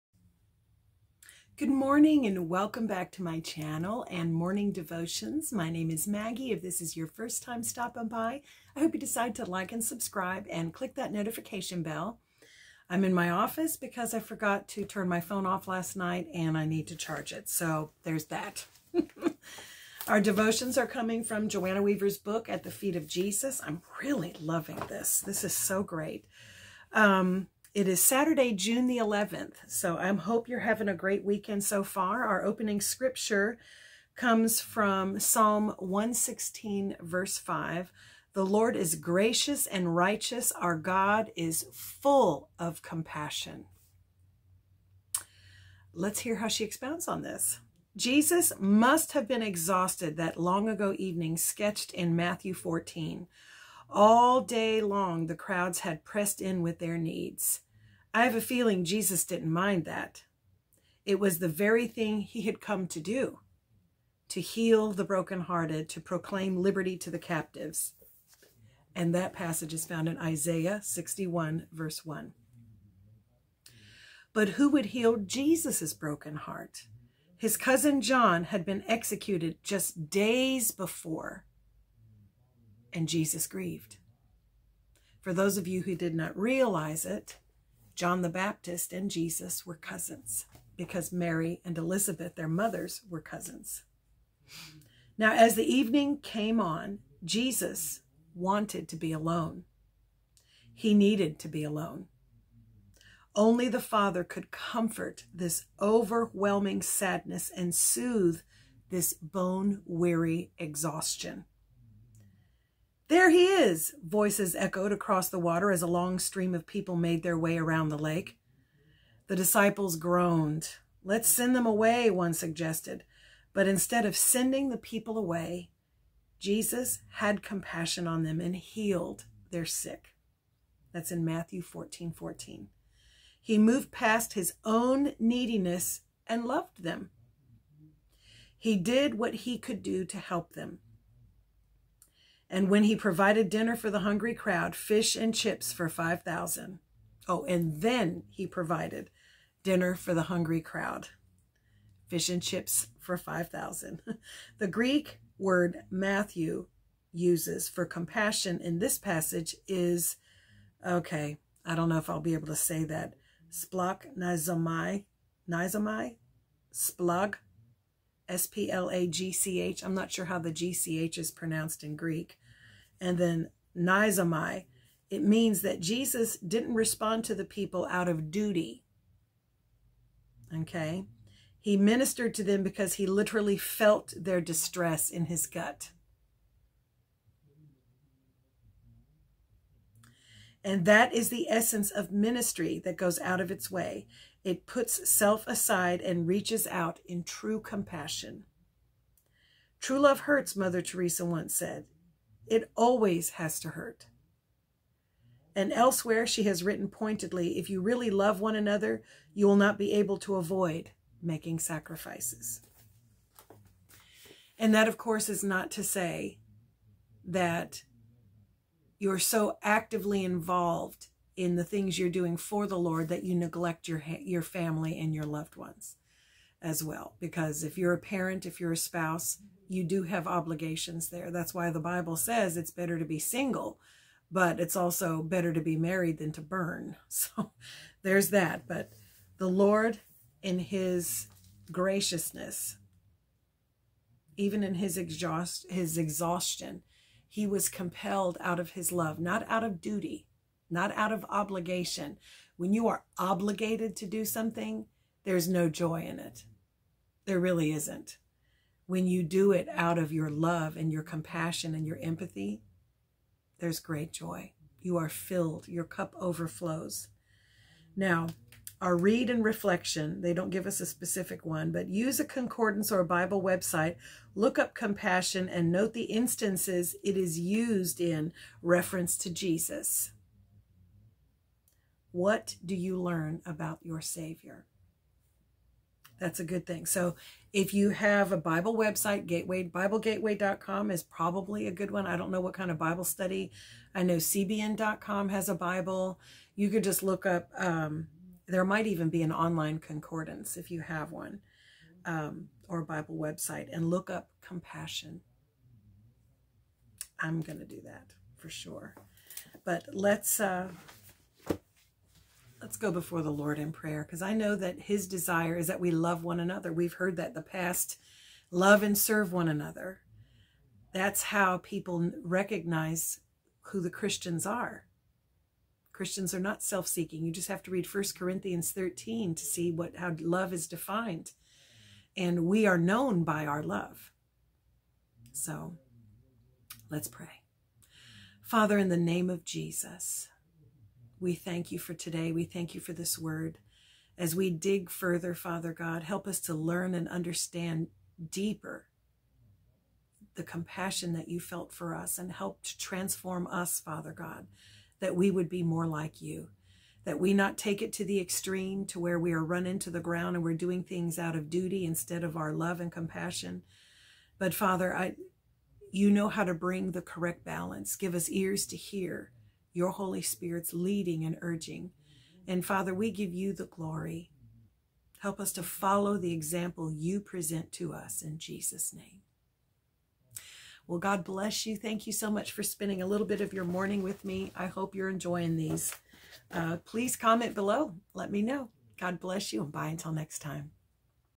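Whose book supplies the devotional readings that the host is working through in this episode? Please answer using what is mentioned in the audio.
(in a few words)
Joanna Weaver.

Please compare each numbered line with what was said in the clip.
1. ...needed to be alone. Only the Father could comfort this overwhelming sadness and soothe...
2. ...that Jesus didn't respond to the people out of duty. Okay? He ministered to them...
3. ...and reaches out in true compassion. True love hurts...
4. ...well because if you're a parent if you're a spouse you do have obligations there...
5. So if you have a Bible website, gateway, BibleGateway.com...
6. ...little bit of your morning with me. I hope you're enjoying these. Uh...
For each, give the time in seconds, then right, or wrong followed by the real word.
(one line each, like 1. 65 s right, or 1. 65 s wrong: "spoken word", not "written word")
1. 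100 s right
2. 175 s right
3. 196 s right
4. 226 s right
5. 286 s right
6. 383 s right.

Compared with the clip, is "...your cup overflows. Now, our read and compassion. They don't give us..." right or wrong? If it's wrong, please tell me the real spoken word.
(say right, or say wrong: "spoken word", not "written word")
wrong: "reflection", not "compassion".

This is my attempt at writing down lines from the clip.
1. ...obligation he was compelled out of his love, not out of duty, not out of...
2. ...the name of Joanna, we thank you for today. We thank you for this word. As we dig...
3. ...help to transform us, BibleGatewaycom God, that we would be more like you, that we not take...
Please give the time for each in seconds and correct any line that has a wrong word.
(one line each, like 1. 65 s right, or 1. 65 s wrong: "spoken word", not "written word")
1. 245 s wrong: "exhaustion", not "obligation"
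2. 338 s wrong: "Jesus", not "Joanna"
3. 352 s wrong: "Father", not "BibleGatewaycom".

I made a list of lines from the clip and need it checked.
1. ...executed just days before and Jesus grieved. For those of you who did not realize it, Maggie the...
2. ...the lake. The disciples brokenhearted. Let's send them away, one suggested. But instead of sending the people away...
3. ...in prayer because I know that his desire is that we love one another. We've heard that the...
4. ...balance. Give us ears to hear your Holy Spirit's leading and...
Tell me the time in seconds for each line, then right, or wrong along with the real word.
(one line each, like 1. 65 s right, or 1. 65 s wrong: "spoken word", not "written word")
1. 78 s wrong: "John", not "Maggie"
2. 117 s wrong: "groaned", not "brokenhearted"
3. 313 s right
4. 367 s right.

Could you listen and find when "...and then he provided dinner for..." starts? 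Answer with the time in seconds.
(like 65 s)
147 s.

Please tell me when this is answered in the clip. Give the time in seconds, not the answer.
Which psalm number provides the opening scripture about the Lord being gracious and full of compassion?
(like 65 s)
35 s.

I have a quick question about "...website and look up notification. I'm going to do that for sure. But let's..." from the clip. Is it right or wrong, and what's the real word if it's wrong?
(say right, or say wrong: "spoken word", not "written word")
wrong: "compassion", not "notification".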